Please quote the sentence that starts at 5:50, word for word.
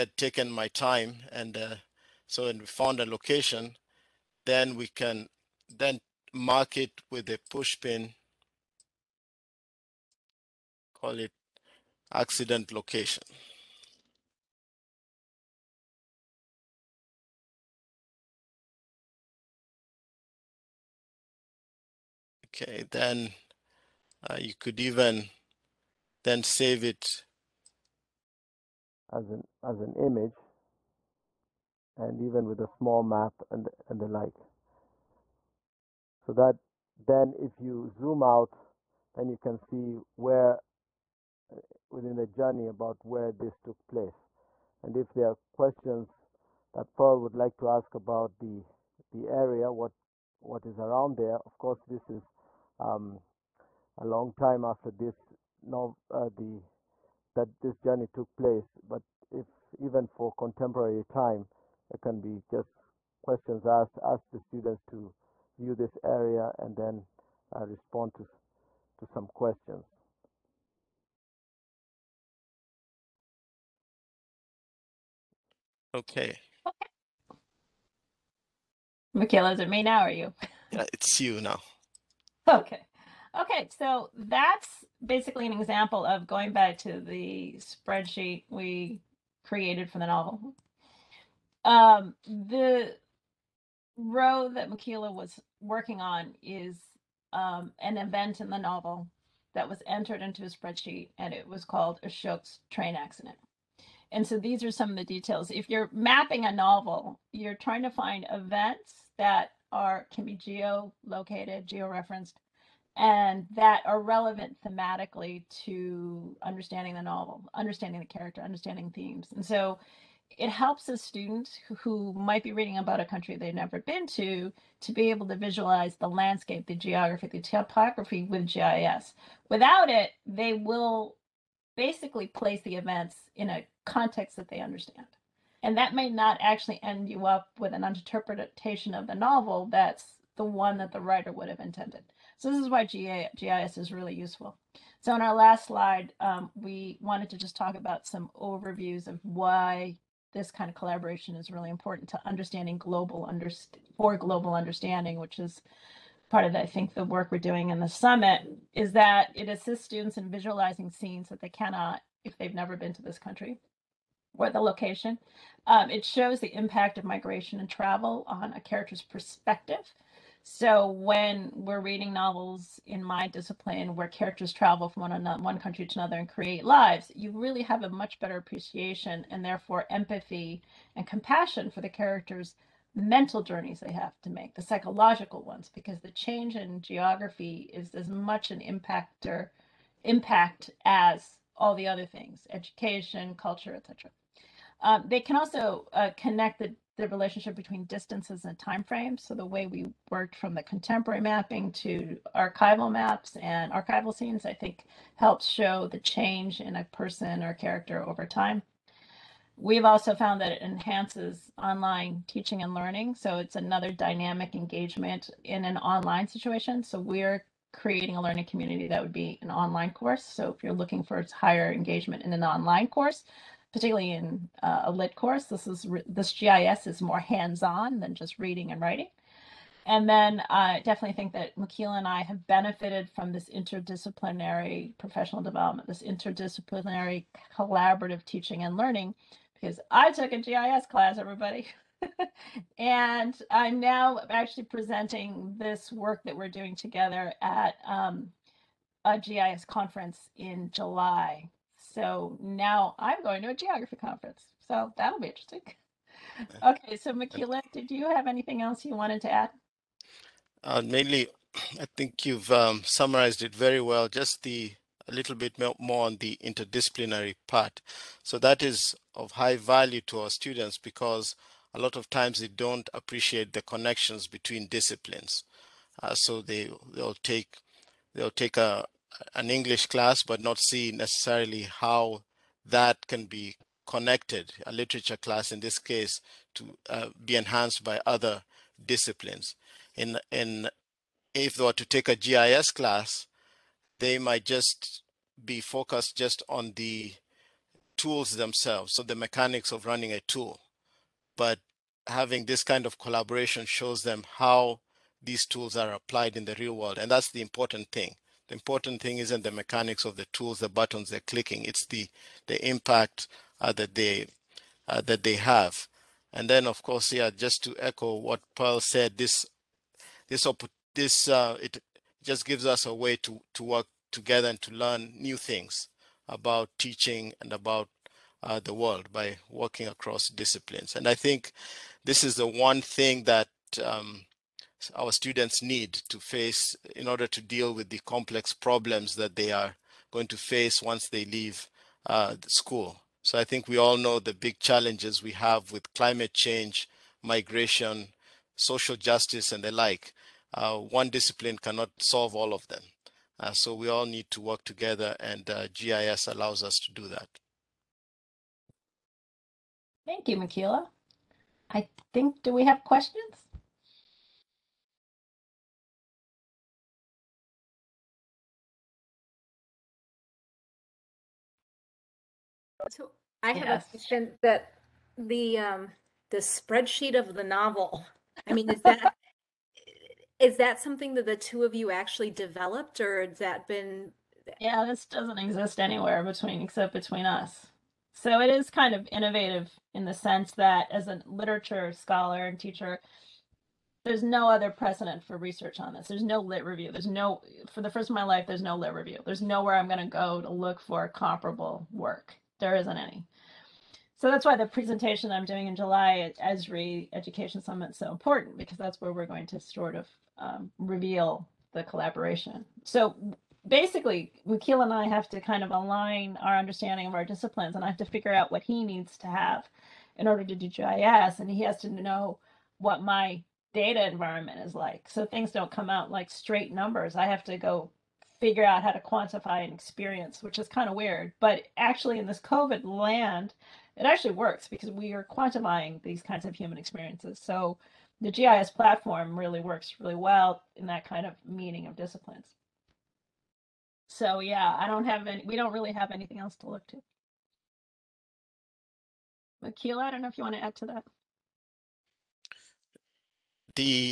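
Uh, one discipline cannot solve all of them.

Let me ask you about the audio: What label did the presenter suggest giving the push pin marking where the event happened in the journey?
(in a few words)
Accident location.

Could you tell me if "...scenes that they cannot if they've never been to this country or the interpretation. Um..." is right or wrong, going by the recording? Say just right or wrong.
wrong.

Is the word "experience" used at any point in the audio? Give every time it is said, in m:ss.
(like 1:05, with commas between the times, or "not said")
7:09, 7:16.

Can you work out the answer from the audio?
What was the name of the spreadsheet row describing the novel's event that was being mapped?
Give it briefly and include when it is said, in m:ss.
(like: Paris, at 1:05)
Ashok's train accident, at 1:42.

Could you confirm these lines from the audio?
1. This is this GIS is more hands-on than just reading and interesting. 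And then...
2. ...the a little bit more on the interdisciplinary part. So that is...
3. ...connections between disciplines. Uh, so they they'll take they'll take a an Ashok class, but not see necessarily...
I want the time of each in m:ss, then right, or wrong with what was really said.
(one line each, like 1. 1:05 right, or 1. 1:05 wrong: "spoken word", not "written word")
1. 3:45 wrong: "writing", not "interesting"
2. 4:24 right
3. 4:33 wrong: "English", not "Ashok".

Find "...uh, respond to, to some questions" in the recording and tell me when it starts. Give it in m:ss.
1:07.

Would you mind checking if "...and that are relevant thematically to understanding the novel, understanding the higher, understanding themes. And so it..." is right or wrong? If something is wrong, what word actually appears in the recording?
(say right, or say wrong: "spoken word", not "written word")
wrong: "character", not "higher".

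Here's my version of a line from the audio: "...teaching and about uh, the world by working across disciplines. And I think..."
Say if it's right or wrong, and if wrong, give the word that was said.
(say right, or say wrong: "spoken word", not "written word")
right.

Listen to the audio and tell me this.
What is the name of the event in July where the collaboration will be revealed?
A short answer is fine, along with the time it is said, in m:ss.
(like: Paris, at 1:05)
Esri Education Summit, at 6:46.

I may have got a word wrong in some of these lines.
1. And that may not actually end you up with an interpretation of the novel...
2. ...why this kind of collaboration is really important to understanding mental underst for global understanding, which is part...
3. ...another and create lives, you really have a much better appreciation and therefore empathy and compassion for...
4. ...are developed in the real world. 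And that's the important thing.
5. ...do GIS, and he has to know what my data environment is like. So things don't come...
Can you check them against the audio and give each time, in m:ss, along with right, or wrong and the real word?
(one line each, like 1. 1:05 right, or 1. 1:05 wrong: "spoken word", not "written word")
1. 2:15 right
2. 2:29 wrong: "global", not "mental"
3. 2:55 right
4. 5:05 wrong: "applied", not "developed"
5. 7:00 right.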